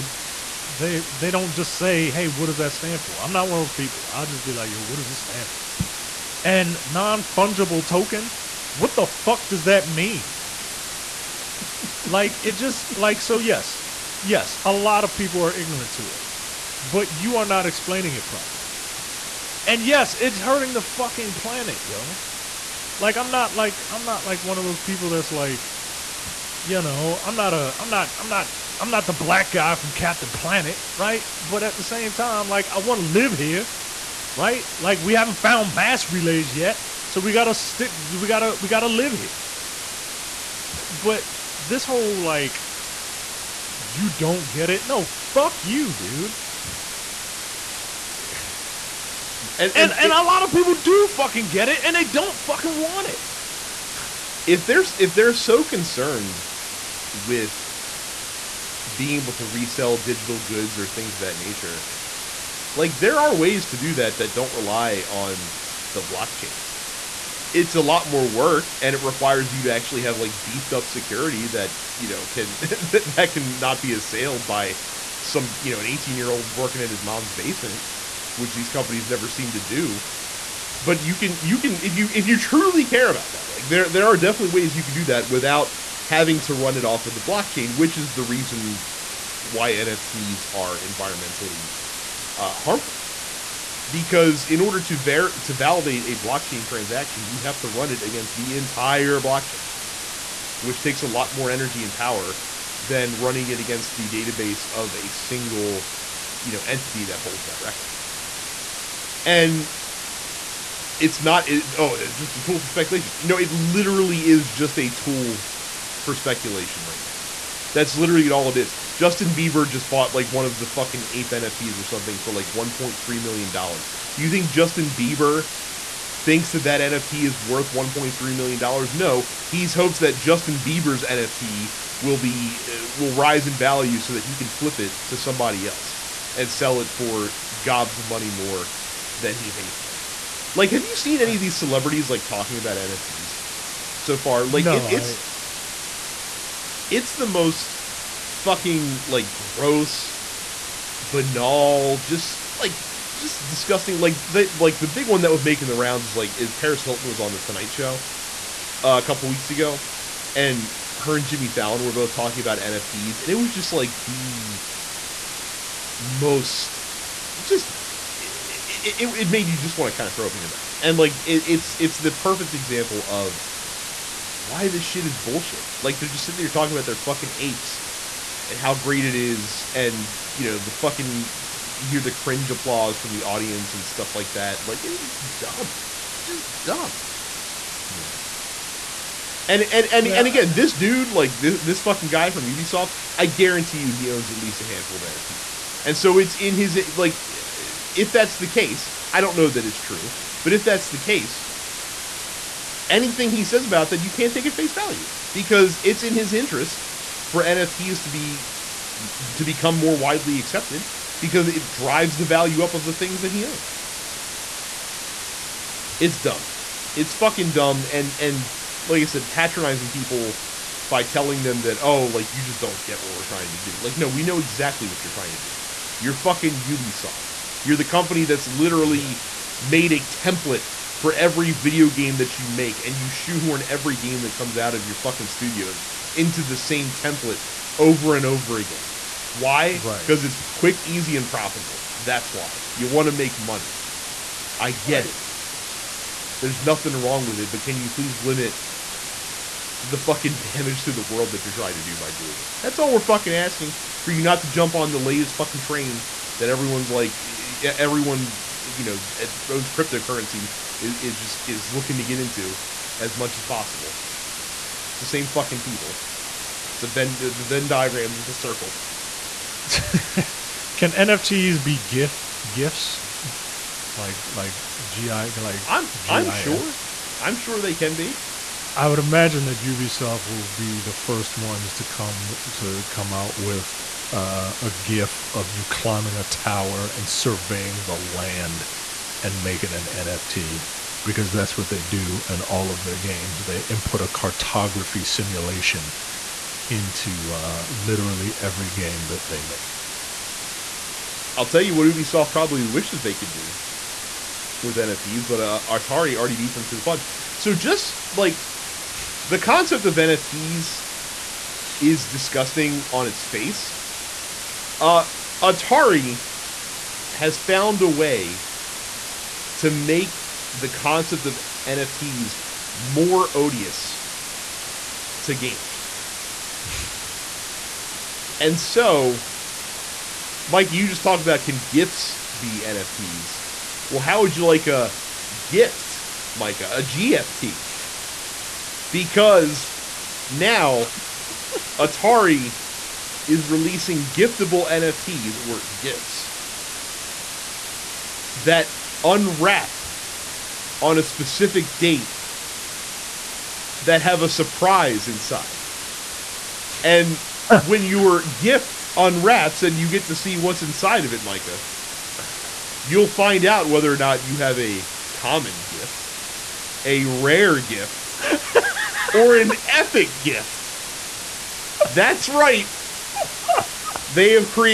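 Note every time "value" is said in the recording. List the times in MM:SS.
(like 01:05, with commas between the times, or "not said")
02:13, 03:24, 03:32.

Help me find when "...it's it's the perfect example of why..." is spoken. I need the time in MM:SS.
02:51.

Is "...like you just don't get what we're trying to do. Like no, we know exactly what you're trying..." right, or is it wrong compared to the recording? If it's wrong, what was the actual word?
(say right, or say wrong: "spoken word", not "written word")
right.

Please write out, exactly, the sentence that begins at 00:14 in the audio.
Yes, a lot of people are ignorant to it.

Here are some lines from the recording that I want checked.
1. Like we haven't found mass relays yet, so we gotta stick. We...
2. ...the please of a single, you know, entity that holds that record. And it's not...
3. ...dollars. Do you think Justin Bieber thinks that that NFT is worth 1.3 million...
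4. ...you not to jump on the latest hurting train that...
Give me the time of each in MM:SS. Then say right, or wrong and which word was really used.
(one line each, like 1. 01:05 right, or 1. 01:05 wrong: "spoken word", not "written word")
1. 00:34 right
2. 01:43 wrong: "database", not "please"
3. 02:03 right
4. 04:14 wrong: "fucking", not "hurting".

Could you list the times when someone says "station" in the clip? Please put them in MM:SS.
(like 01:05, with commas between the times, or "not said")
not said.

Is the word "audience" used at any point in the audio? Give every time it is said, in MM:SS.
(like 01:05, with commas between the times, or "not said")
03:03.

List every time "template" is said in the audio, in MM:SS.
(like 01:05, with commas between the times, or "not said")
03:50, 03:56.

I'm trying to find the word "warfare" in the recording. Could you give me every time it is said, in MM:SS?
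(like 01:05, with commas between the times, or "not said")
not said.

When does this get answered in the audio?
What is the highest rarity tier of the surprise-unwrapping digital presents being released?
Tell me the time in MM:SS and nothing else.
06:09.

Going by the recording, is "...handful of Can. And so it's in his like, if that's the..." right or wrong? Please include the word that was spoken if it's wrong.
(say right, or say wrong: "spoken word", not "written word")
wrong: "NFTs", not "Can".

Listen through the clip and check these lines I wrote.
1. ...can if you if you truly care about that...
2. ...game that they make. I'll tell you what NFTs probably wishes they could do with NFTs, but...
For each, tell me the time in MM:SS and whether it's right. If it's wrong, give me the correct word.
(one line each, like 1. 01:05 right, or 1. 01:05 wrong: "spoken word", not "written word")
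1. 01:21 right
2. 04:58 wrong: "Ubisoft", not "NFTs".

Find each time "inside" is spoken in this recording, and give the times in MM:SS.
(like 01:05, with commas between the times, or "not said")
05:55, 06:00.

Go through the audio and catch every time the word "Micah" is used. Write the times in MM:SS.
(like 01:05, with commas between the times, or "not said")
05:36, 06:01.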